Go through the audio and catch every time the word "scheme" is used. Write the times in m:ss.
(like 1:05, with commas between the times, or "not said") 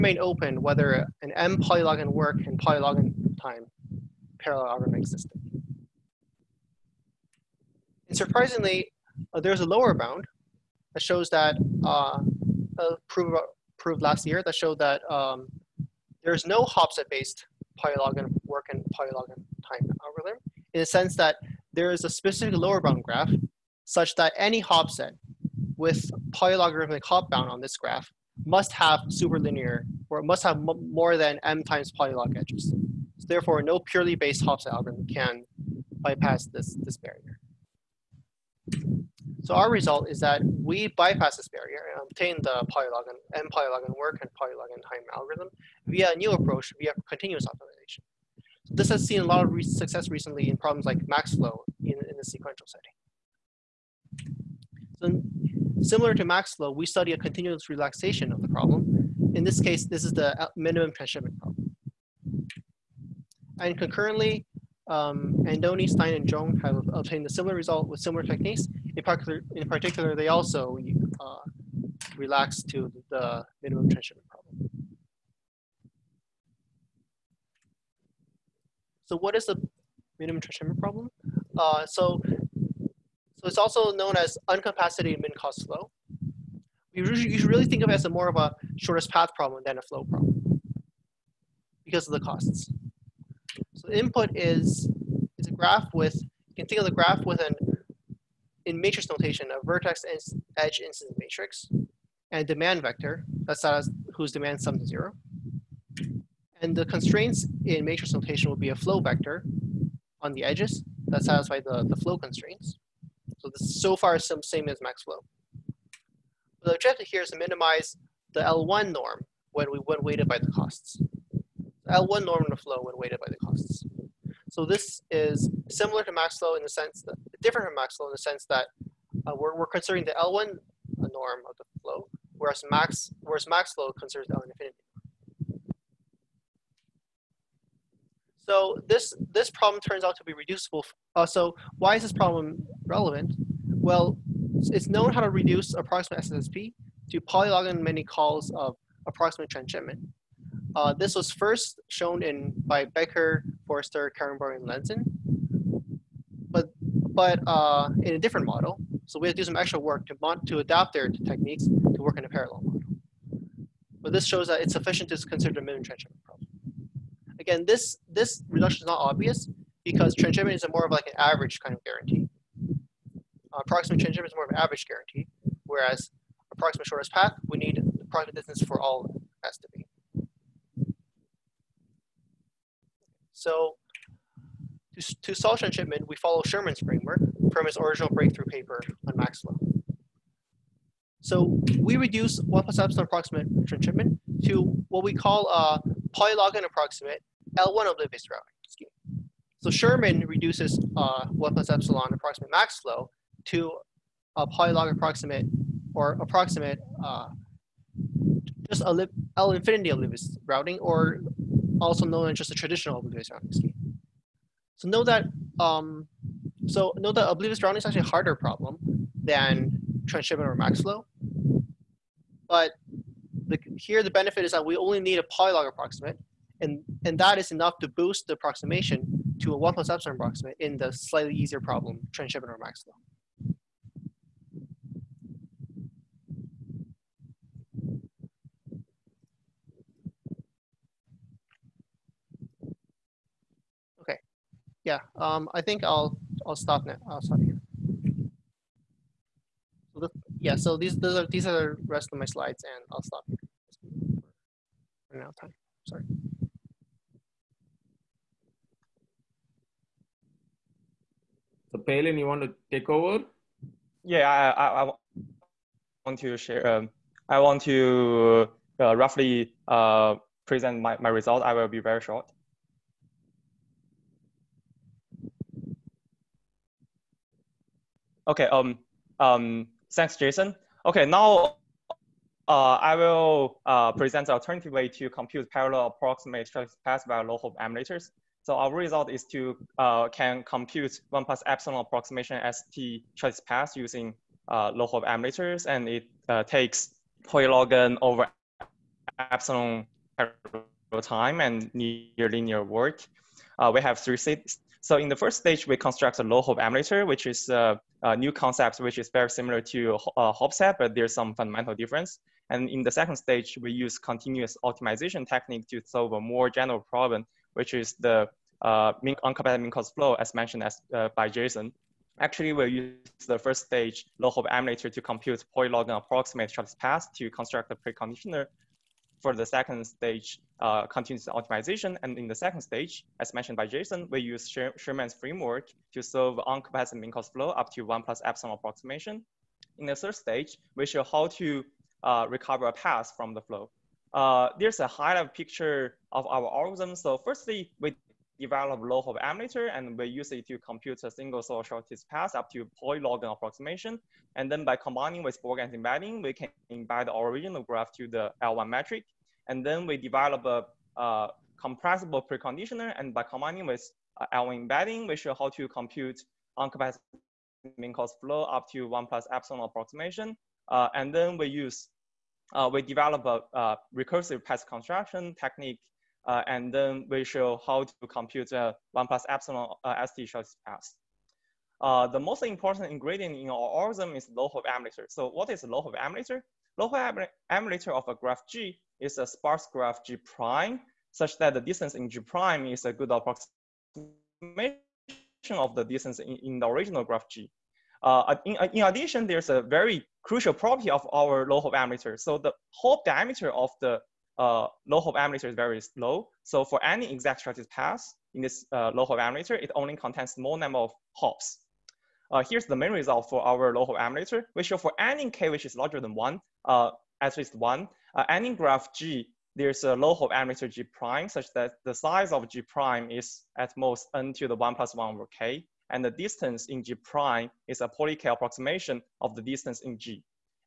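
3:18, 3:33.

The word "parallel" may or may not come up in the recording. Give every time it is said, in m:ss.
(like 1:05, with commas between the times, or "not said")
2:42, 4:45.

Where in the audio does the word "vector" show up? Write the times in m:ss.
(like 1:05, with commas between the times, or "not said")
1:42, 1:48.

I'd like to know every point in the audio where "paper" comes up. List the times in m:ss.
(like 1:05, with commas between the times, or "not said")
3:08.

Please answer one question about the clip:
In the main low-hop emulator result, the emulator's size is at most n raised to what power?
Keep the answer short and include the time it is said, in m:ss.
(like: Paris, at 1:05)
1 plus 1 over k, at 7:04.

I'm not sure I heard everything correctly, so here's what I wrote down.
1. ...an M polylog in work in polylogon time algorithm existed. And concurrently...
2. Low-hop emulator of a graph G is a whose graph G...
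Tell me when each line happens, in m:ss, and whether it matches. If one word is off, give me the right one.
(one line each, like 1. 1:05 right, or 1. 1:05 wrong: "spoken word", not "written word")
1. 0:01 wrong: "surprisingly", not "concurrently"
2. 6:26 wrong: "sparse", not "whose".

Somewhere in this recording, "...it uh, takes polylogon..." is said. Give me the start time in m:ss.
4:55.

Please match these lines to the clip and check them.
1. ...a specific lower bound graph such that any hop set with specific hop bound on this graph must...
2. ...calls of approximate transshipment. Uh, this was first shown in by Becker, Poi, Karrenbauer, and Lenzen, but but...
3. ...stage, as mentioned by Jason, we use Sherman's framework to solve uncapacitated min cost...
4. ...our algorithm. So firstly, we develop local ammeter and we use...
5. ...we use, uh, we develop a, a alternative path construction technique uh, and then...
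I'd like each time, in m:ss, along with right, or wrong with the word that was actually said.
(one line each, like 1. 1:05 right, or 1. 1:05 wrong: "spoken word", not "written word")
1. 0:22 wrong: "polylogarithmic", not "specific"
2. 2:28 wrong: "Forster", not "Poi"
3. 5:32 right
4. 5:46 right
5. 6:11 wrong: "recursive", not "alternative".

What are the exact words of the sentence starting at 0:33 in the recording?
So therefore, no purely based set algorithm can bypass this, this barrier.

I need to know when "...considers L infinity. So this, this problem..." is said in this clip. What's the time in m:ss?
2:13.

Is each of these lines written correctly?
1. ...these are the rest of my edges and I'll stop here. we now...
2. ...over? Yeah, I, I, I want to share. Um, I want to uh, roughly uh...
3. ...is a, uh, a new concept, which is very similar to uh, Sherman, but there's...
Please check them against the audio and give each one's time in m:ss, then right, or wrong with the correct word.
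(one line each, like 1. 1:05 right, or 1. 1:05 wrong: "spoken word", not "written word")
1. 4:11 wrong: "slides", not "edges"
2. 4:22 right
3. 5:07 wrong: "Hopset", not "Sherman".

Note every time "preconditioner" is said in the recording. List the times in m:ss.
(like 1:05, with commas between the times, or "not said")
5:27, 6:02.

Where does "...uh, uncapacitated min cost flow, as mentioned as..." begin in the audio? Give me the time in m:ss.
5:18.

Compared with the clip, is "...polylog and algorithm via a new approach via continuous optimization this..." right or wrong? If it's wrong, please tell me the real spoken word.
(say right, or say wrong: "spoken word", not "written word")
right.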